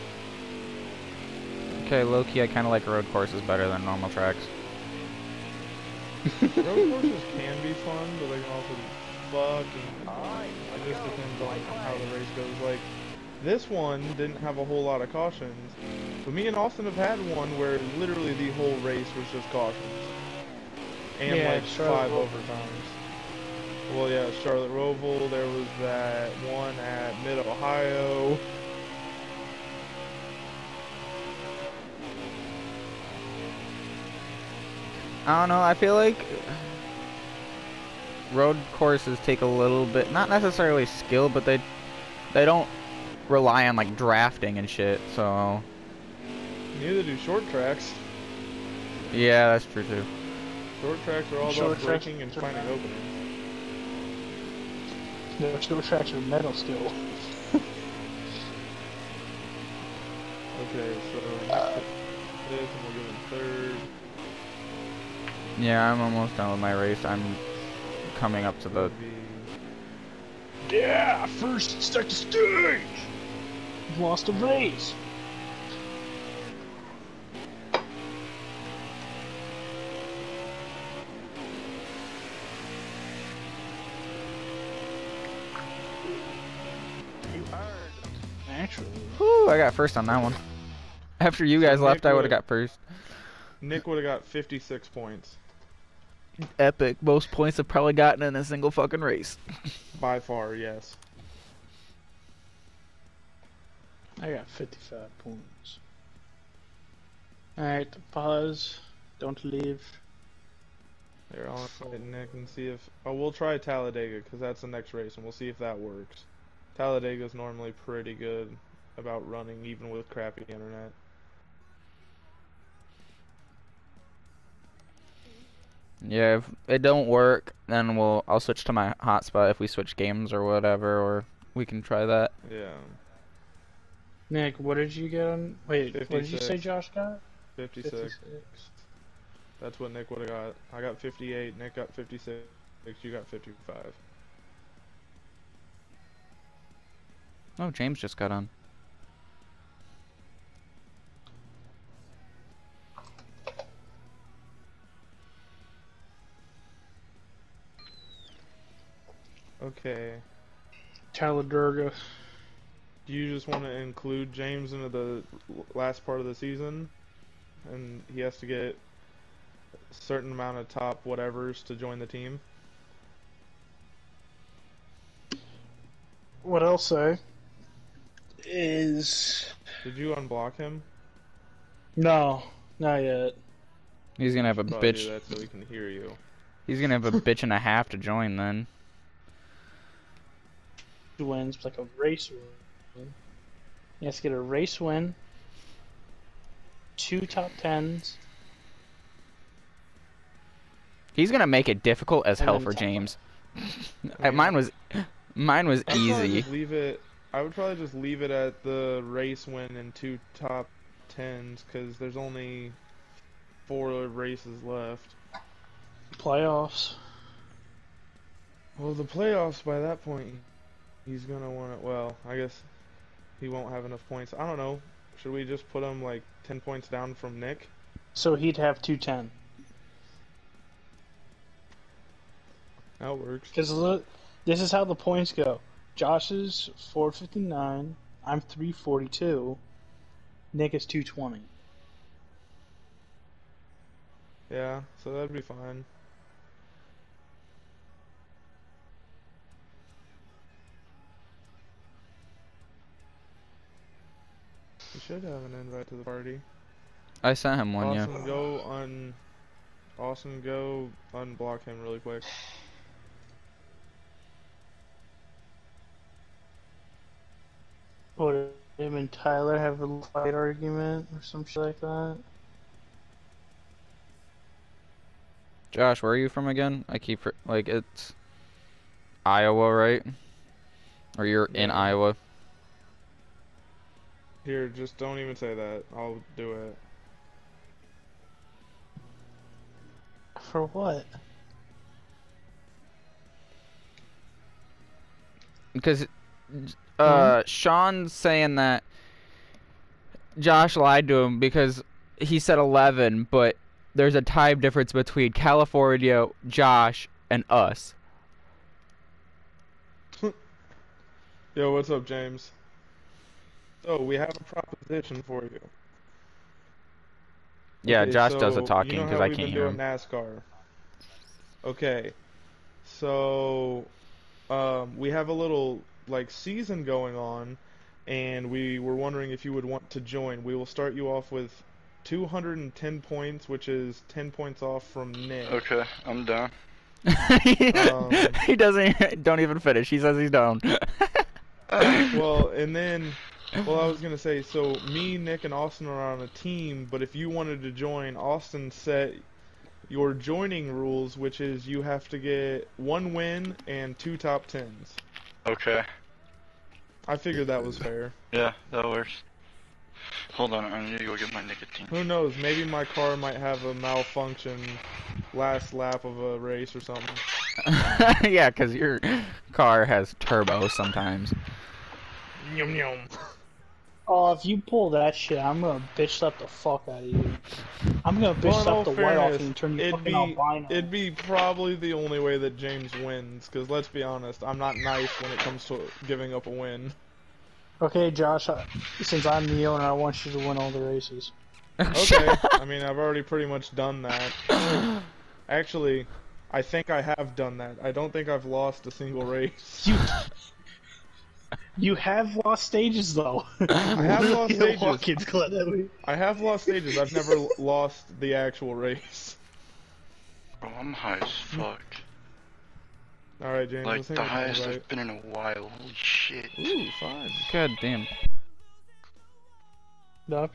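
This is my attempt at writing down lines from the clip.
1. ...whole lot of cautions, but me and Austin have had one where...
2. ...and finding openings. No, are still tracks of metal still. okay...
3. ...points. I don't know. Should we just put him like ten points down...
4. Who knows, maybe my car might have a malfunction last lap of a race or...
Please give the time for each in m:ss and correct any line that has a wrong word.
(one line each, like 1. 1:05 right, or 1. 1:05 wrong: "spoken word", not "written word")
1. 0:14 right
2. 0:52 right
3. 3:44 right
4. 6:01 right.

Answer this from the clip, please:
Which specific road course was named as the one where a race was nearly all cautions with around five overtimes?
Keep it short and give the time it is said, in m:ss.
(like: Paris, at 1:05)
Charlotte Roval, at 0:24.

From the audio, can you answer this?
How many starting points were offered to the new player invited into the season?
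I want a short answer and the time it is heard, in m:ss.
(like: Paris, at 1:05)
210, at 5:32.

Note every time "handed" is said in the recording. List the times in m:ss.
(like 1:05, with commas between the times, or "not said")
not said.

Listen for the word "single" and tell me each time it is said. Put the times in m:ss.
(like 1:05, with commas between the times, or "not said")
1:38, 6:38.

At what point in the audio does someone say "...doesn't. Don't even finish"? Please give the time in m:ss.
5:38.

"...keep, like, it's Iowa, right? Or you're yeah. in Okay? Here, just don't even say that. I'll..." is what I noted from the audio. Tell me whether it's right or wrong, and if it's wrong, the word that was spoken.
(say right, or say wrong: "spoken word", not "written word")
wrong: "Iowa", not "Okay".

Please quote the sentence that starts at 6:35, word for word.
Actually, I think I have done that.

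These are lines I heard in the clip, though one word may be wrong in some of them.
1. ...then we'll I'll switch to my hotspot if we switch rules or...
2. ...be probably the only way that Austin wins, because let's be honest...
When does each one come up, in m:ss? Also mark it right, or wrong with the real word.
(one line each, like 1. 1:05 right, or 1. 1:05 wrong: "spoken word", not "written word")
1. 2:07 wrong: "games", not "rules"
2. 6:20 wrong: "James", not "Austin".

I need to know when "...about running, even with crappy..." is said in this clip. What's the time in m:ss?
1:58.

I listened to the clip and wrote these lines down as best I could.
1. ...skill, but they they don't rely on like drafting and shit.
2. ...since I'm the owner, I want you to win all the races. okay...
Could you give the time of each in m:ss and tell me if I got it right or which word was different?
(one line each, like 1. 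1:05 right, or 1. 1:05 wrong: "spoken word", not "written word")
1. 0:40 right
2. 6:29 right.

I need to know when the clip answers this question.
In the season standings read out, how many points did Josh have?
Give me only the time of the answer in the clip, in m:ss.
3:55.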